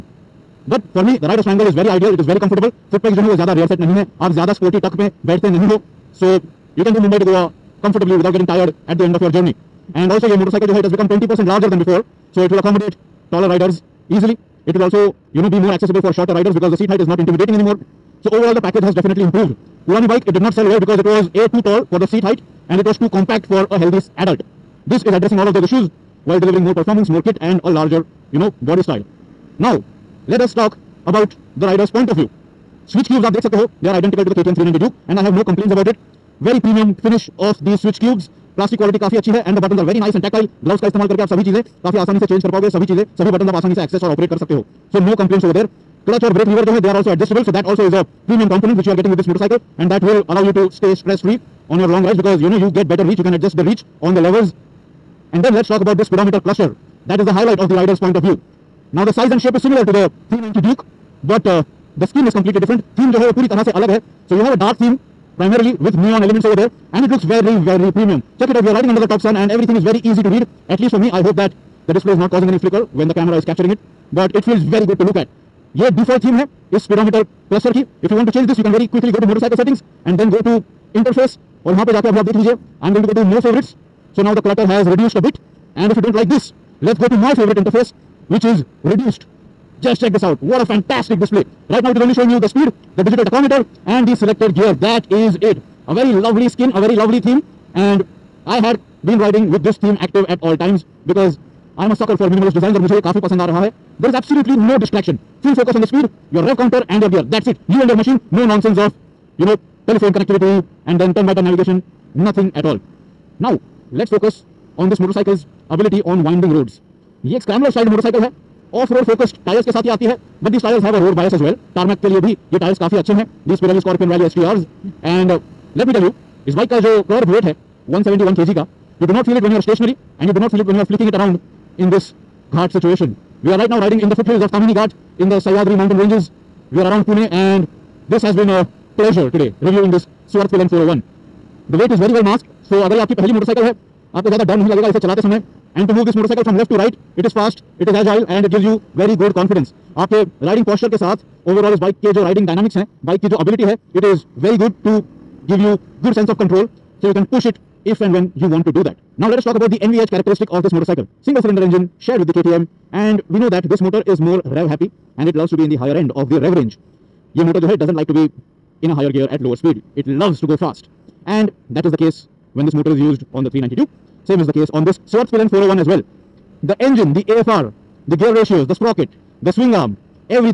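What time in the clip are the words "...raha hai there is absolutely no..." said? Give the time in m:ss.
1:43.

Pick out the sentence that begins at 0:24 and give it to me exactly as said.
This is addressing all of those issues while delivering more performance, more kit and a larger you know body style.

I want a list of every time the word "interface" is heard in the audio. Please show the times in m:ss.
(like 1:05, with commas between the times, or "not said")
1:20, 1:27.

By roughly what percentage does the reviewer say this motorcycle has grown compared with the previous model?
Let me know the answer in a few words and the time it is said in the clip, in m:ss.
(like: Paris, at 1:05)
20%, at 0:11.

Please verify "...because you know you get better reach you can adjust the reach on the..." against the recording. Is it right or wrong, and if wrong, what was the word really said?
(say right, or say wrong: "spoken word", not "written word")
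right.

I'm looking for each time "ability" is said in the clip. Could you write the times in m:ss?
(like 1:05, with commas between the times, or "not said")
1:55.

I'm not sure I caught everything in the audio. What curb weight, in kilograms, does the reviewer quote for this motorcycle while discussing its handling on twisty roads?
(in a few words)
171 kg.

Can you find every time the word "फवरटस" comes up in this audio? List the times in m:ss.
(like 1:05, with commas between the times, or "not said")
1:23.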